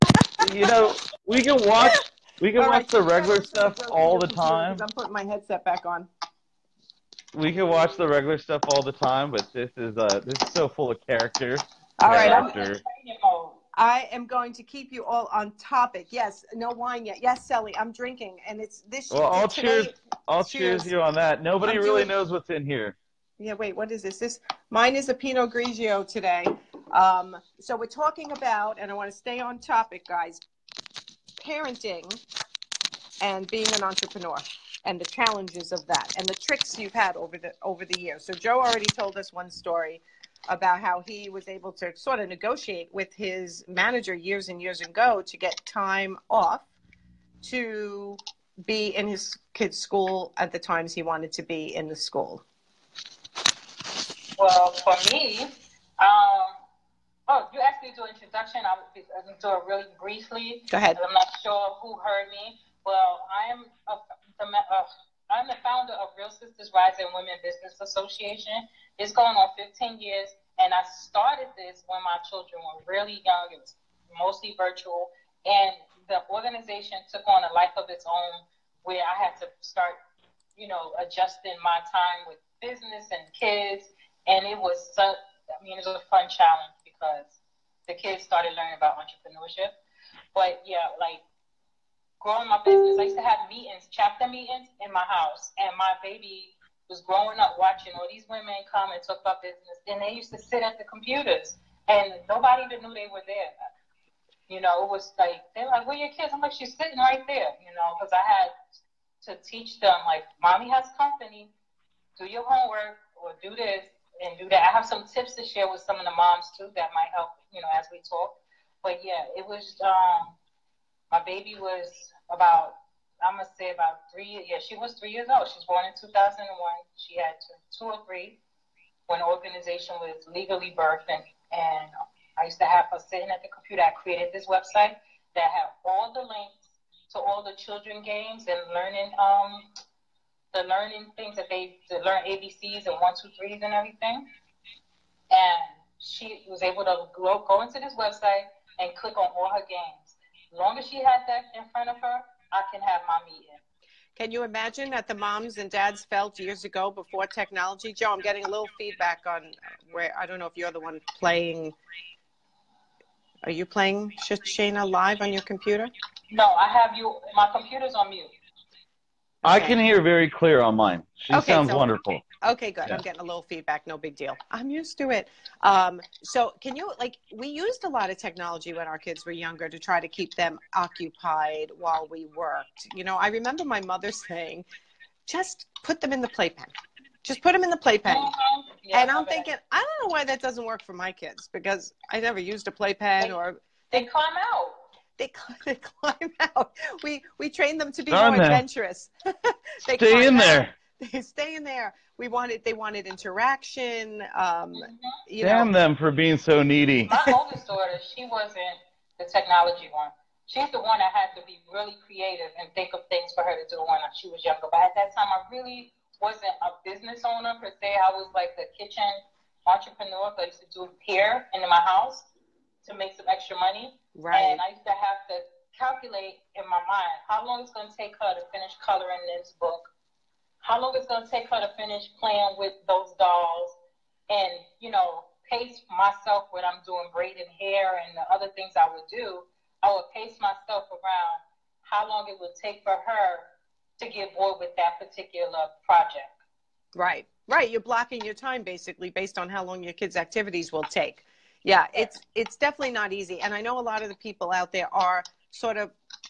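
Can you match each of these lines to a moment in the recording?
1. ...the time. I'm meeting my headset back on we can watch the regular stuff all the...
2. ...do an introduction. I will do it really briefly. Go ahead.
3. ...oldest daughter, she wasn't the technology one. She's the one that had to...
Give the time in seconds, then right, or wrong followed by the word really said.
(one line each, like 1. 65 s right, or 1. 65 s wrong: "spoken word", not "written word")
1. 4 s wrong: "putting", not "meeting"
2. 57 s right
3. 207 s right.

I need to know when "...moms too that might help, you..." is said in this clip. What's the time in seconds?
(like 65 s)
116 s.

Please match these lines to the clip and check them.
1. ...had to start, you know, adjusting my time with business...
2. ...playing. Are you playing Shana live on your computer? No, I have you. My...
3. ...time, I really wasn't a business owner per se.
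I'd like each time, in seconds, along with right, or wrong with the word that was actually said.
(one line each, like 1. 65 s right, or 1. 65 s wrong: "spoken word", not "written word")
1. 79 s right
2. 161 s right
3. 215 s right.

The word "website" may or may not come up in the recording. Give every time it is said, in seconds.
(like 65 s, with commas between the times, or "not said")
134 s, 147 s.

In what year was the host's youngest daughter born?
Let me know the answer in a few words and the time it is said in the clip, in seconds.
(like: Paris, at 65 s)
2001, at 125 s.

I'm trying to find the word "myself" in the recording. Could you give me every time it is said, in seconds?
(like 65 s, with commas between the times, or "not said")
235 s, 240 s.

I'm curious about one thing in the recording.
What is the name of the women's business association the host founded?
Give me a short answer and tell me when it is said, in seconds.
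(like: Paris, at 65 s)
Real Sisters Rising Women Business Association, at 66 s.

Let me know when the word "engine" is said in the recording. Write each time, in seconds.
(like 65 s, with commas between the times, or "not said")
not said.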